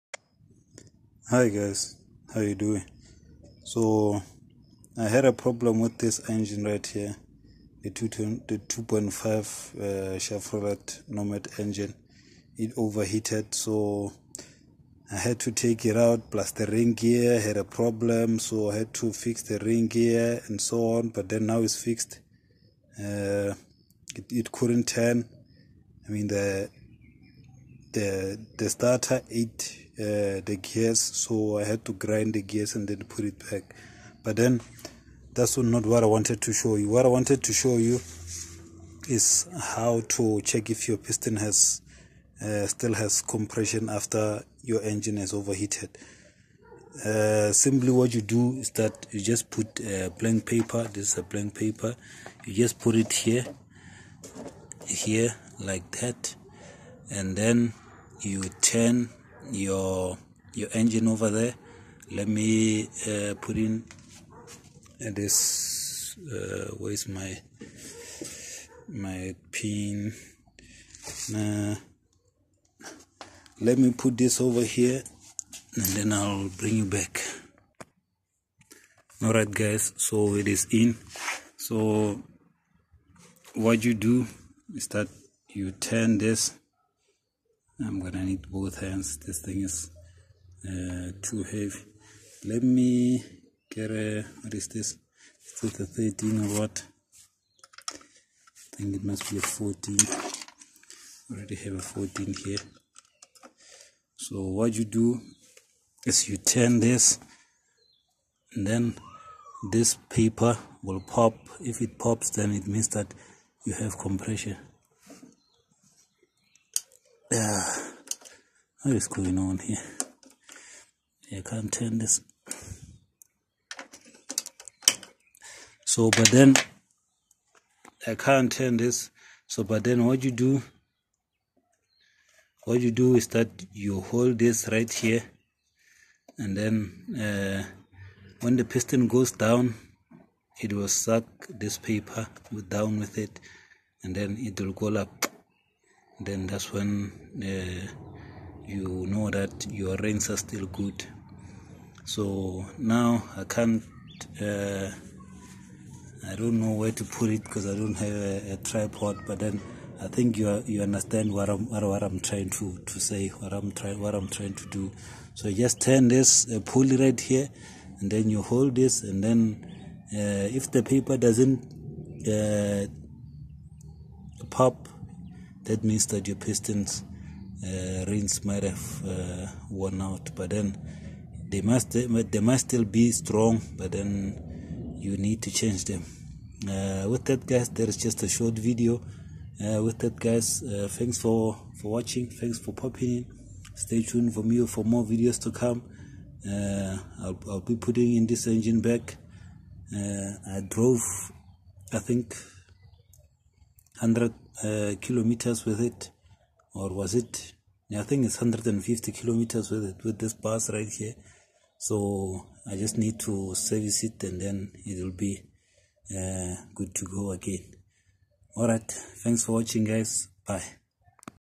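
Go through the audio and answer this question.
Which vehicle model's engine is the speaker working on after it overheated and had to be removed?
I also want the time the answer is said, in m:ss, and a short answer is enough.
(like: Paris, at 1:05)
Chevrolet Nomad, at 0:10.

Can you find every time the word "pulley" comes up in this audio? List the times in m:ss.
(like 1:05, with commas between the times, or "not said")
2:46.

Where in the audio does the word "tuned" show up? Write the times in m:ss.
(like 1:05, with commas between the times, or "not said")
3:14.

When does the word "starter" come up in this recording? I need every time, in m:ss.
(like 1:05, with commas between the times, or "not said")
0:28.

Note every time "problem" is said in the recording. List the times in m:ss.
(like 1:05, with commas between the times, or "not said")
0:05, 0:17.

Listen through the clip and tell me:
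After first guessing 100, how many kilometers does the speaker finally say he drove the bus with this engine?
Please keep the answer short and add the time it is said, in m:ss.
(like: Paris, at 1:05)
150 kilometers, at 3:28.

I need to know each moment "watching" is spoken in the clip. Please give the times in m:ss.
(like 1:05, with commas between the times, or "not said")
3:11, 3:39.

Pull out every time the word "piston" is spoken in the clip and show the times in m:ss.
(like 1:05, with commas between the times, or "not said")
0:40, 2:18, 2:56.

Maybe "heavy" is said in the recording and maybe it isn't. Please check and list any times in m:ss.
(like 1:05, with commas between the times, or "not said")
1:31.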